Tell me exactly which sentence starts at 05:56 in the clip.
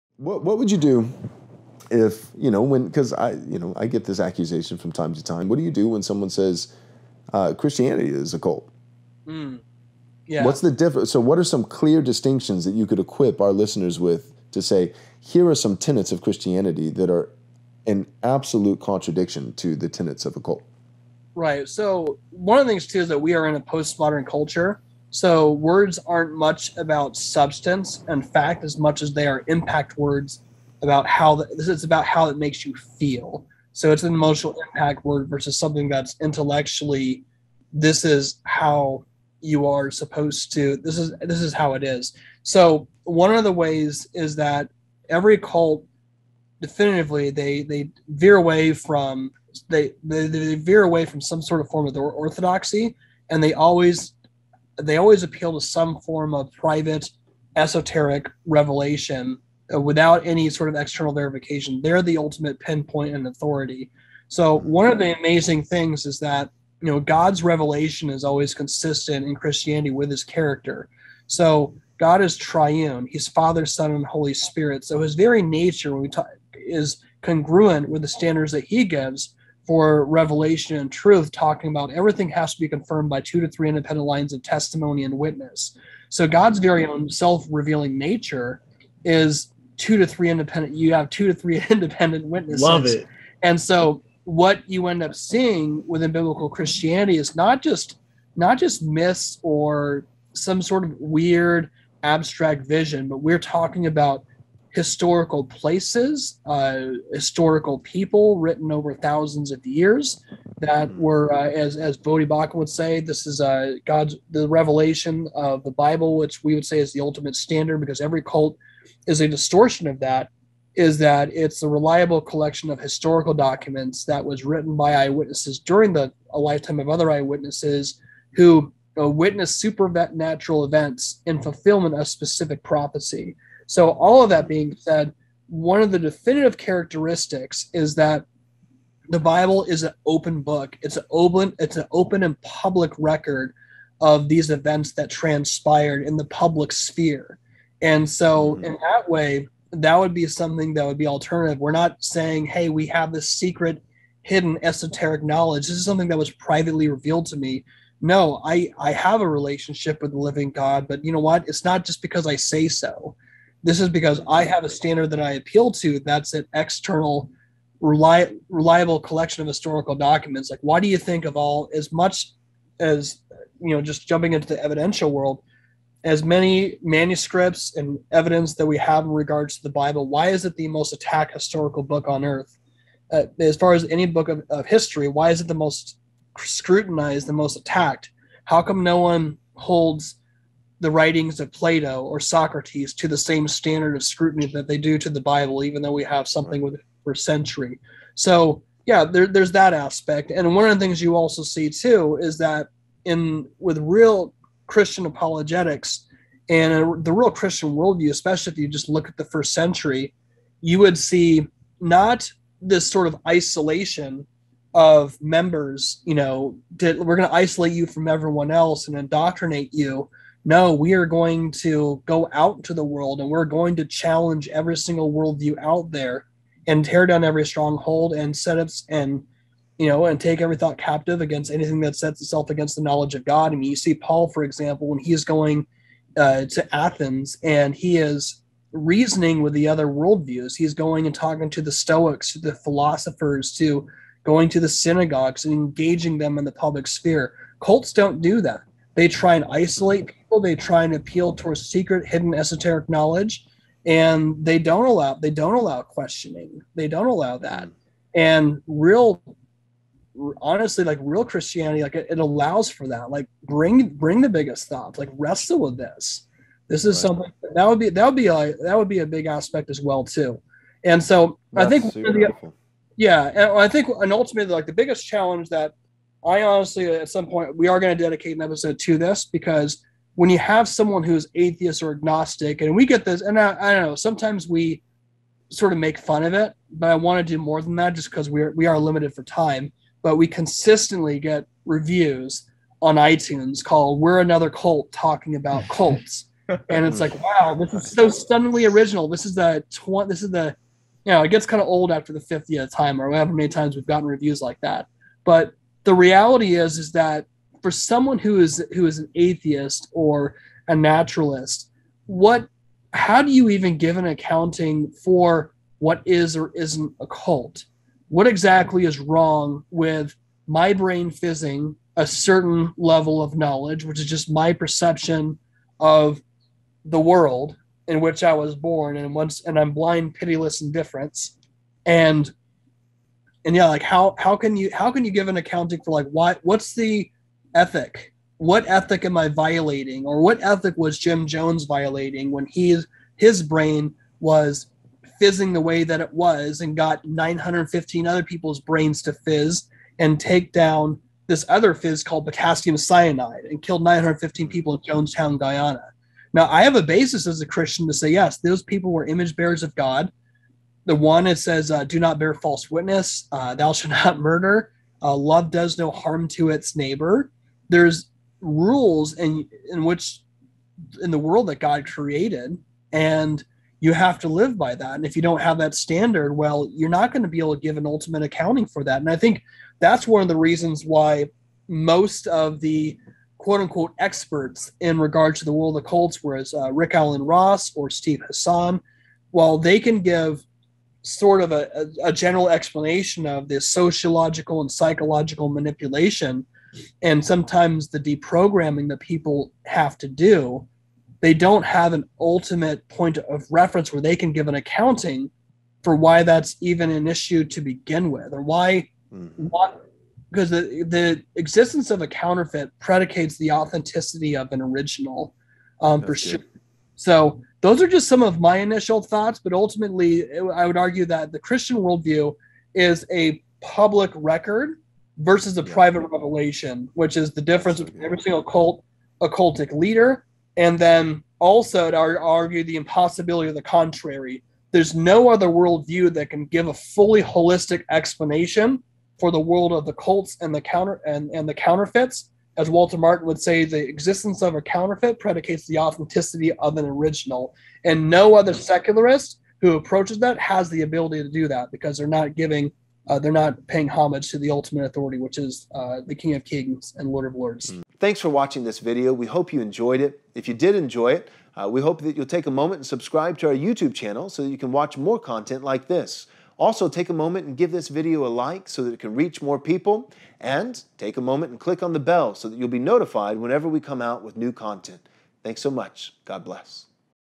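Now, I have a basis as a Christian to say, yes, those people were image bearers of God.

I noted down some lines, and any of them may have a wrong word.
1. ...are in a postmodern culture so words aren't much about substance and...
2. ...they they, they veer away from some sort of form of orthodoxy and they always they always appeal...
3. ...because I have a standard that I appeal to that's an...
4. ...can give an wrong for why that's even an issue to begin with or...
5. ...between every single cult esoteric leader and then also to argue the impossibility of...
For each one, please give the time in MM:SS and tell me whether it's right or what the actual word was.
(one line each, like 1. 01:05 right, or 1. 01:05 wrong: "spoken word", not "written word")
1. 00:23 right
2. 00:49 right
3. 02:43 right
4. 06:44 wrong: "accounting", not "wrong"
5. 07:07 wrong: "occultic", not "esoteric".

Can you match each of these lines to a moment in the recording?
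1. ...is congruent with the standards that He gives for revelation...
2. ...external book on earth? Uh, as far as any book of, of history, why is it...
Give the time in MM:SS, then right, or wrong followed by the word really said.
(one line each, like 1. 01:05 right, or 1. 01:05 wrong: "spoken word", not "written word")
1. 01:16 right
2. 03:01 wrong: "historical", not "external".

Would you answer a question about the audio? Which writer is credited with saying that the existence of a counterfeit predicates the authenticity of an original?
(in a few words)
Walter Martin.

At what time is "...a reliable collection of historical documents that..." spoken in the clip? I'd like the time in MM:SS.
02:01.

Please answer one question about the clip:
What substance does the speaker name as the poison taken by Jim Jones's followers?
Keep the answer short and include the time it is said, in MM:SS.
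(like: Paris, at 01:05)
potassium cyanide, at 05:52.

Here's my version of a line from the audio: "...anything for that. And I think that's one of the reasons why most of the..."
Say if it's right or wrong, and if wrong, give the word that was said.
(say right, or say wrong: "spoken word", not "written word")
wrong: "accounting", not "anything".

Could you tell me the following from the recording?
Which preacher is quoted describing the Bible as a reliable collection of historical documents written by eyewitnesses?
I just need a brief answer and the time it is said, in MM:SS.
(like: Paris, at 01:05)
Voddie Baucham, at 01:51.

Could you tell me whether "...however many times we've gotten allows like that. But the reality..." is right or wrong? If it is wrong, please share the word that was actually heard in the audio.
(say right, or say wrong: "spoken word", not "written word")
wrong: "reviews", not "allows".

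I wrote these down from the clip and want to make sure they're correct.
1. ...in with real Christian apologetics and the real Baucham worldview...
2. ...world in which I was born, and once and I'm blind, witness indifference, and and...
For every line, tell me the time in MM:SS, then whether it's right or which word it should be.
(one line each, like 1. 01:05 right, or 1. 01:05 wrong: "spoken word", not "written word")
1. 03:23 wrong: "Christian", not "Baucham"
2. 05:26 wrong: "pitiless", not "witness".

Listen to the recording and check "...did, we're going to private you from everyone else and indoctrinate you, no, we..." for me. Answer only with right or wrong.
wrong.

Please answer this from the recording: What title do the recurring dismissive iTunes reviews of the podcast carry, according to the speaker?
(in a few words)
We're Another Cult.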